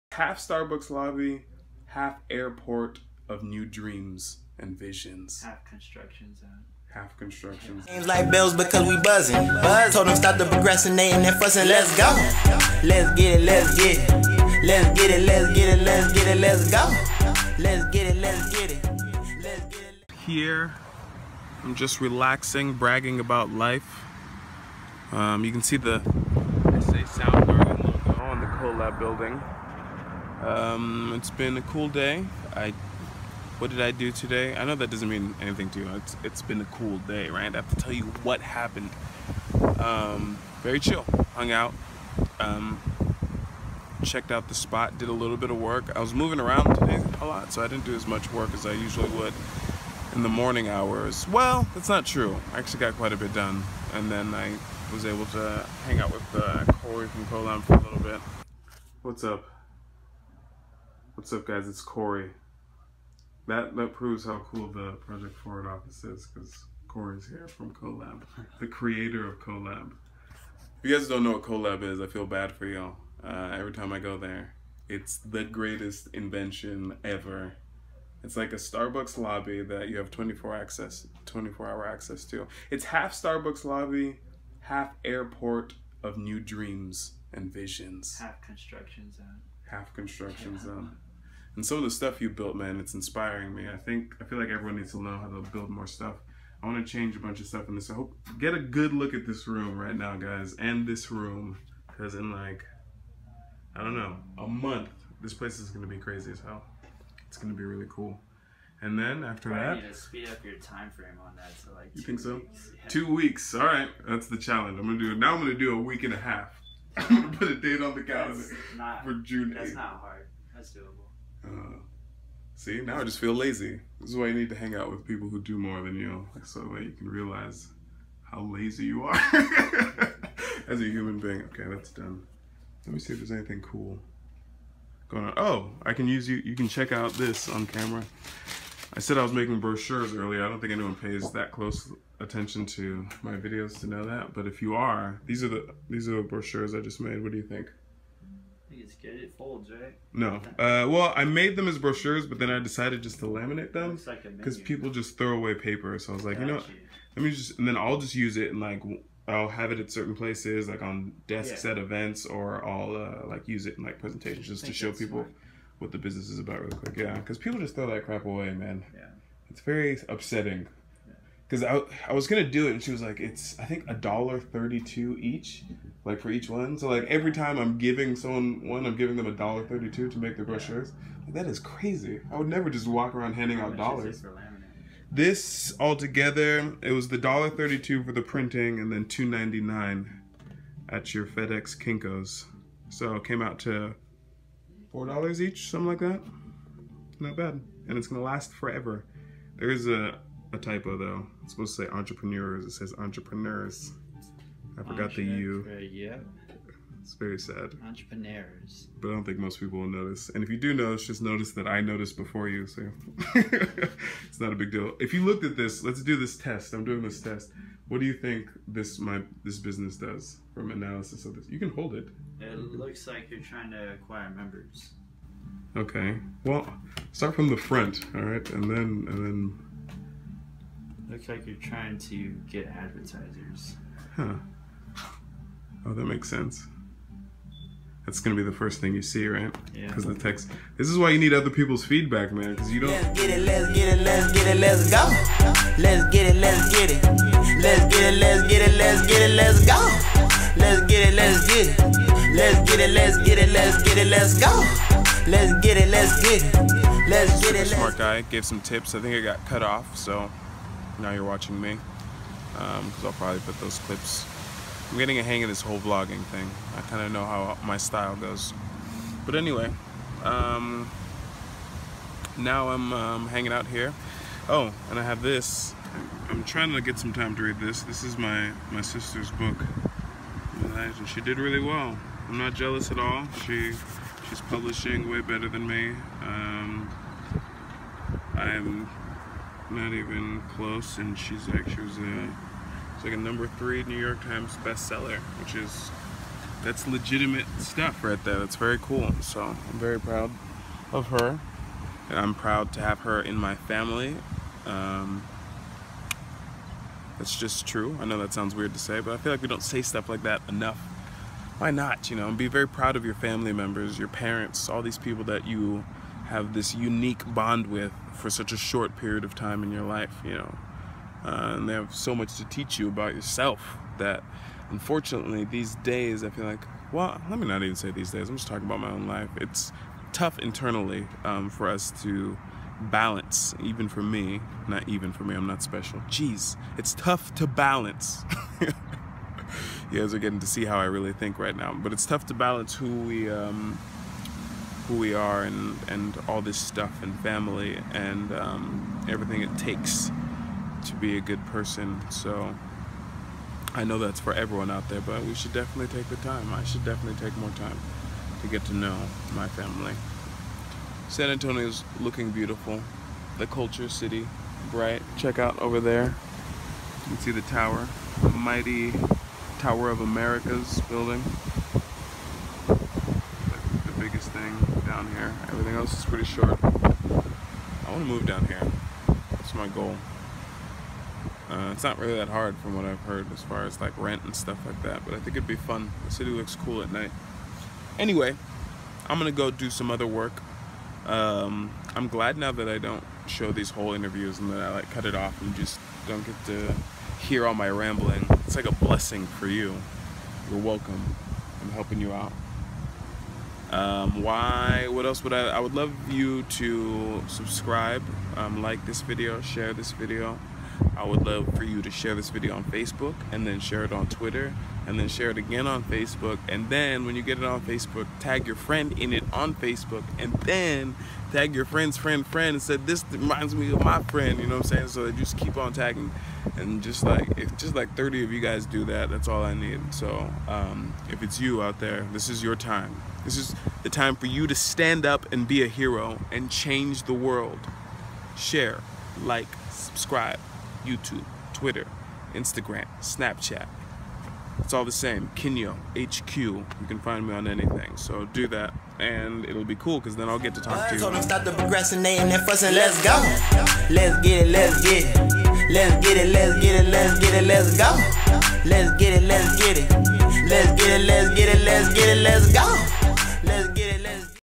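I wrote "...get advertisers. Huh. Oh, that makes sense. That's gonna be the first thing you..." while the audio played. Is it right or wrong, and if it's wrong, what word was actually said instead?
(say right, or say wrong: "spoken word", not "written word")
right.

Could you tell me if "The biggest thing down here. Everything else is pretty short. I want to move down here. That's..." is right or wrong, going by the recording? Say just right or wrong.
right.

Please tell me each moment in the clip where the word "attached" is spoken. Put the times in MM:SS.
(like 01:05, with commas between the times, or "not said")
not said.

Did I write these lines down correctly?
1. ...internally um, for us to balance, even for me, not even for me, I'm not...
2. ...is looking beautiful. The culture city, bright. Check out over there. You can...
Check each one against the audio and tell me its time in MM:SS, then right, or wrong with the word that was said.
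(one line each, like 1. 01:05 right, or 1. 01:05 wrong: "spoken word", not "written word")
1. 05:30 right
2. 06:01 right.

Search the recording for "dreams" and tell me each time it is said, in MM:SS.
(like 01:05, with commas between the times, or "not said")
00:03, 01:26.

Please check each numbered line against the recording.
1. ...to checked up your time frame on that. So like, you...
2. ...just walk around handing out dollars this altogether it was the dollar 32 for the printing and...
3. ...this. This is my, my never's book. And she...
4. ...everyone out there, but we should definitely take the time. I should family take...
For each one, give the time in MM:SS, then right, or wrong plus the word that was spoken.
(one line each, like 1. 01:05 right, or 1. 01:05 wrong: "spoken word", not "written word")
1. 01:49 wrong: "speed", not "checked"
2. 03:02 right
3. 04:37 wrong: "sister", not "never"
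4. 05:54 wrong: "definitely", not "family".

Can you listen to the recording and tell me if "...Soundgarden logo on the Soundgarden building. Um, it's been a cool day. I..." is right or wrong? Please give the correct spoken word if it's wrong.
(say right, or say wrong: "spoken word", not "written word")
wrong: "Colab", not "Soundgarden".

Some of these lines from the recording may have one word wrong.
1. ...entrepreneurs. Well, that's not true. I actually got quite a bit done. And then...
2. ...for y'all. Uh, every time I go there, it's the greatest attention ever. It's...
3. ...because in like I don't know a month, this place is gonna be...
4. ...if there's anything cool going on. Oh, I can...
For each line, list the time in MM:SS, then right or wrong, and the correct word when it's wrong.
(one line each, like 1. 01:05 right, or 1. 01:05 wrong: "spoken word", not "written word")
1. 00:50 wrong: "hours", not "entrepreneurs"
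2. 01:12 wrong: "invention", not "attention"
3. 01:41 right
4. 02:13 right.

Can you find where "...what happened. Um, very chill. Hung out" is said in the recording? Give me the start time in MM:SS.
00:38.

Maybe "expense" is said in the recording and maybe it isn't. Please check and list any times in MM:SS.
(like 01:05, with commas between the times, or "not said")
not said.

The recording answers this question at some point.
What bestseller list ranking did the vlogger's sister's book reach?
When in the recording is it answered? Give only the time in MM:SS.
04:53.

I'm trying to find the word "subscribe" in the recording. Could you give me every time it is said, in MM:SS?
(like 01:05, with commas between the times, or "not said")
06:47, 07:19.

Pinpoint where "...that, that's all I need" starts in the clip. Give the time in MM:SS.
07:08.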